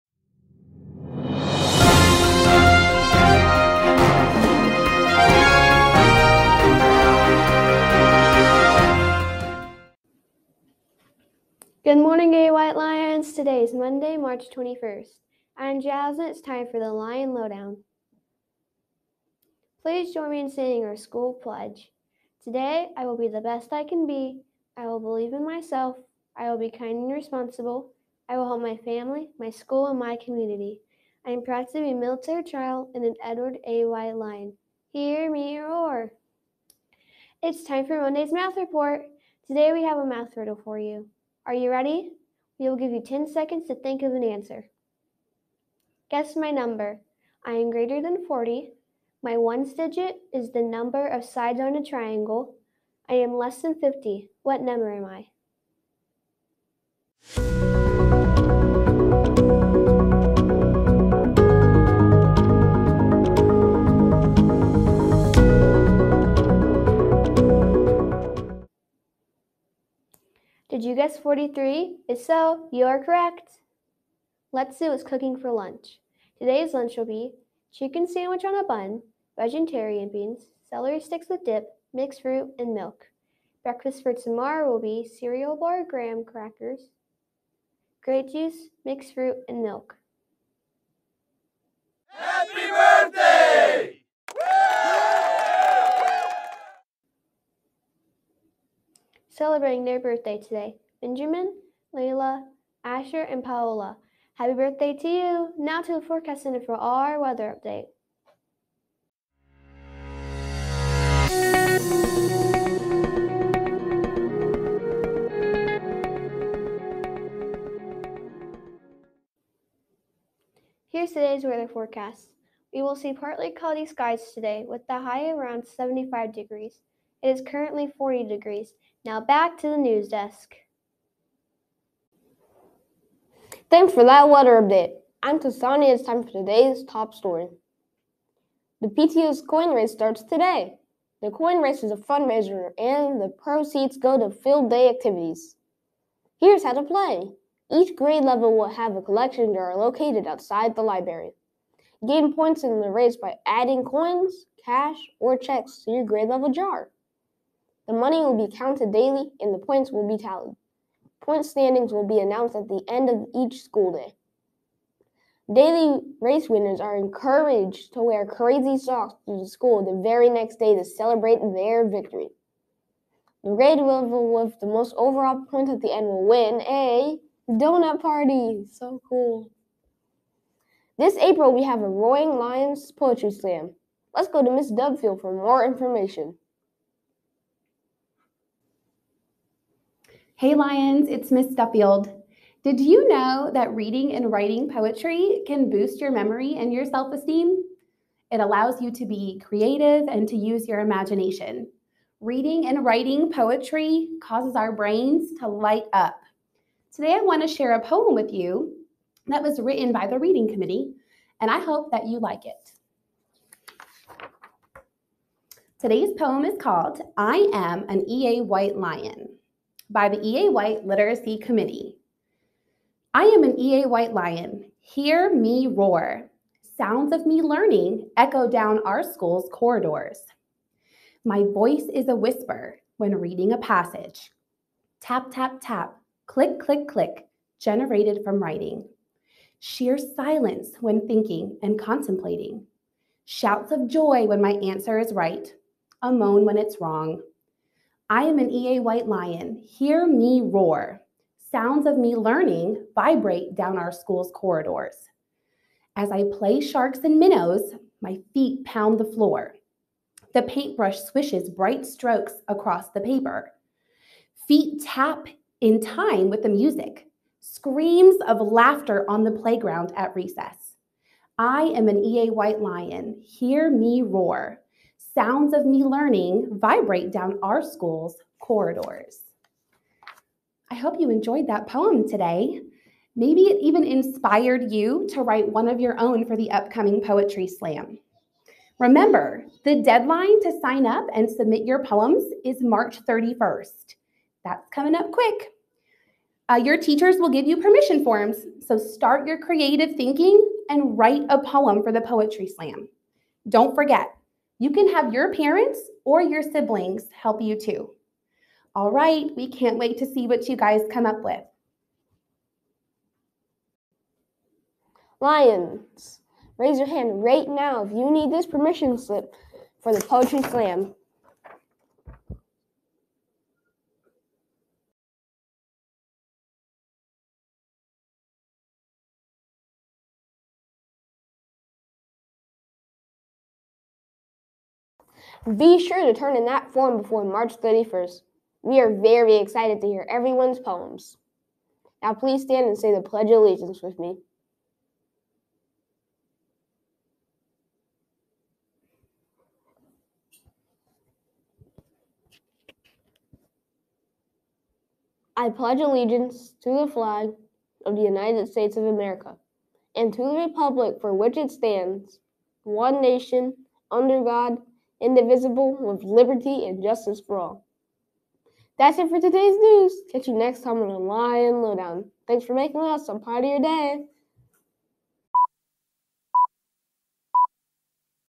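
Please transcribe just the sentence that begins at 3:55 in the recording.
Tap, tap, tap, click, click, click, generated from writing.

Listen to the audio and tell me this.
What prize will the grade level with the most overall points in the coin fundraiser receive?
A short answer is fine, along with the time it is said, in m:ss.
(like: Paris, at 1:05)
a donut party, at 2:57.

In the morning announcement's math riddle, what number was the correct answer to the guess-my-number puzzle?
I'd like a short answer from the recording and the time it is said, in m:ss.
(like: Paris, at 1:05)
43, at 1:11.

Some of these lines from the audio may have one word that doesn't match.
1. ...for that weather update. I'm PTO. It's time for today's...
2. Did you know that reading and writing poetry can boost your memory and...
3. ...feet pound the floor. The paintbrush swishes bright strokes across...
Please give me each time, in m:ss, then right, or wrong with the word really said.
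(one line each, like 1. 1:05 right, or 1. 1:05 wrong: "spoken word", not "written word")
1. 2:13 wrong: "Tasani", not "PTO"
2. 3:12 right
3. 4:18 right.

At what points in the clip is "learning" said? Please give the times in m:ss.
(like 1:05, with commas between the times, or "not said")
3:47, 4:12, 4:35.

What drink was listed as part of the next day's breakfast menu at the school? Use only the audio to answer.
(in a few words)
grape juice.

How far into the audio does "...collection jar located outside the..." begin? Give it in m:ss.
2:29.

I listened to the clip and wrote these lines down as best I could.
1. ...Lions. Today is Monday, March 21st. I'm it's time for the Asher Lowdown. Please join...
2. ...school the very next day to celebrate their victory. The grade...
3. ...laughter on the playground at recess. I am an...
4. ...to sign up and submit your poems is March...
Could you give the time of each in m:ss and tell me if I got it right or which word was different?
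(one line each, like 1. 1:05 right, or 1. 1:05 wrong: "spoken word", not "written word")
1. 0:12 wrong: "Lion", not "Asher"
2. 2:49 right
3. 4:28 right
4. 4:50 right.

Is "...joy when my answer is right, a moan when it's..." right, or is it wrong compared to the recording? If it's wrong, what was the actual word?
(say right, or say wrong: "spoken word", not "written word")
right.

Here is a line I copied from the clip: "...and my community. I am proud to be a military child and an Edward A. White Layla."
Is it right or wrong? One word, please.
wrong.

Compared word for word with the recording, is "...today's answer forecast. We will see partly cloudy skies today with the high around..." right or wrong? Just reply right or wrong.
wrong.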